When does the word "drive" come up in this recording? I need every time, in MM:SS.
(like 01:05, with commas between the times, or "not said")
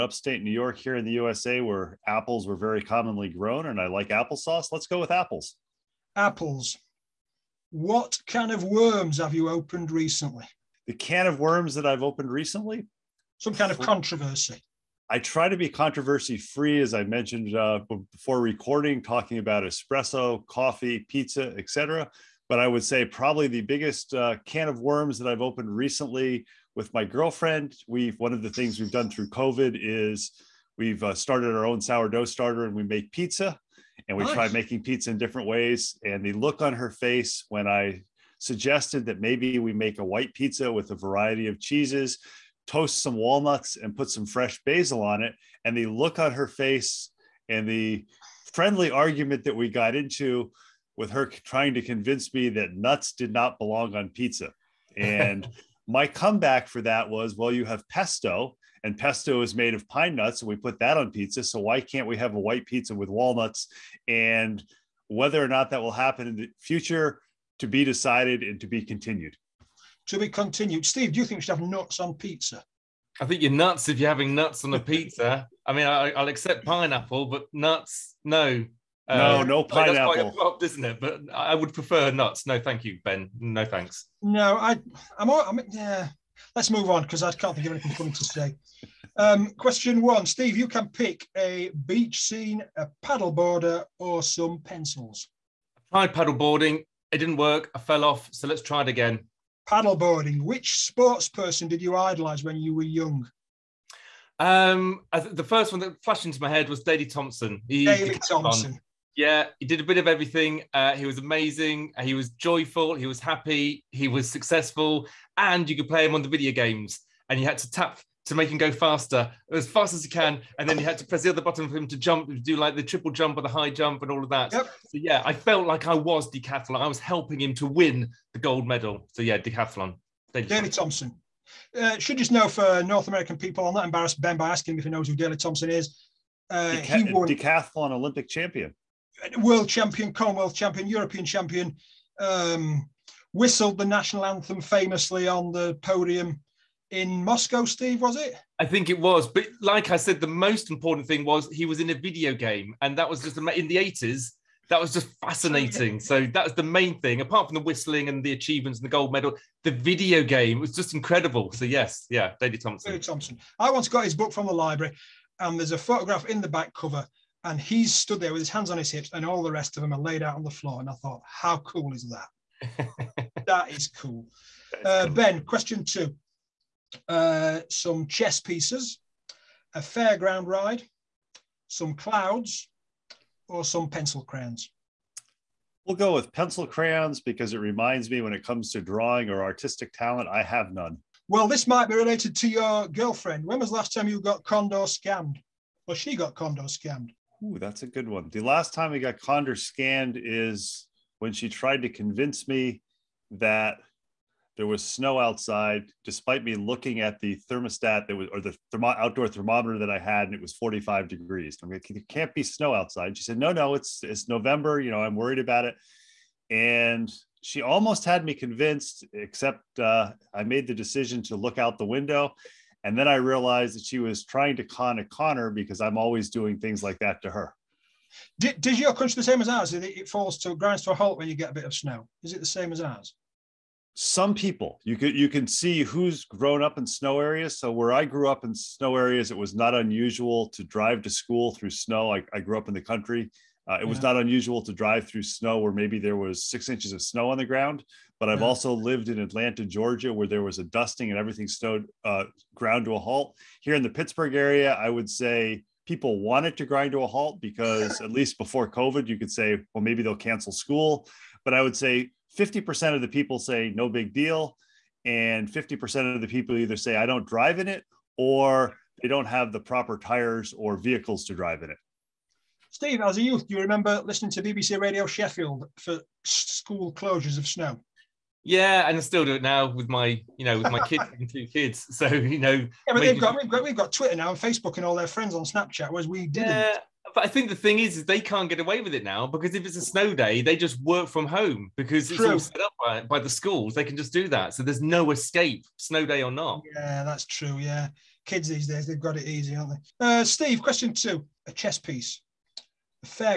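04:00, 04:04, 04:27, 04:31.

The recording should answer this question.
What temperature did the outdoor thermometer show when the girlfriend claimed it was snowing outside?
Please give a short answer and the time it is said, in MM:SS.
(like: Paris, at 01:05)
45 degrees, at 03:30.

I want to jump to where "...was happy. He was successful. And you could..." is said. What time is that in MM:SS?
01:53.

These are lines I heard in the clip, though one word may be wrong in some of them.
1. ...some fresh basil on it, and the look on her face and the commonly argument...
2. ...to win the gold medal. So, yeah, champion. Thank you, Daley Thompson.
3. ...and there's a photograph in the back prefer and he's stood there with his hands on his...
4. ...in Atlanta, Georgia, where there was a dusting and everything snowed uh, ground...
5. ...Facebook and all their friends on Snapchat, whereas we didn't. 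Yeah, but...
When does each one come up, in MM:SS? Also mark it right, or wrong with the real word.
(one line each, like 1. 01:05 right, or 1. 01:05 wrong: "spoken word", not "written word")
1. 00:44 wrong: "friendly", not "commonly"
2. 02:07 wrong: "decathlon", not "champion"
3. 02:45 wrong: "cover", not "prefer"
4. 04:09 right
5. 04:44 right.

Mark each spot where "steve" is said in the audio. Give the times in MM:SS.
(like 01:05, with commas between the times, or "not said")
01:10, 01:30, 02:27, 04:32, 05:00.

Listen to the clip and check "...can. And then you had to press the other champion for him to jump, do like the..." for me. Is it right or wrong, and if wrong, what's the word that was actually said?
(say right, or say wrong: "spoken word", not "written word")
wrong: "button", not "champion".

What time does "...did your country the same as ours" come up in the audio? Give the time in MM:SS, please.
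03:48.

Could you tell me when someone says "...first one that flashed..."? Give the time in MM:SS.
01:45.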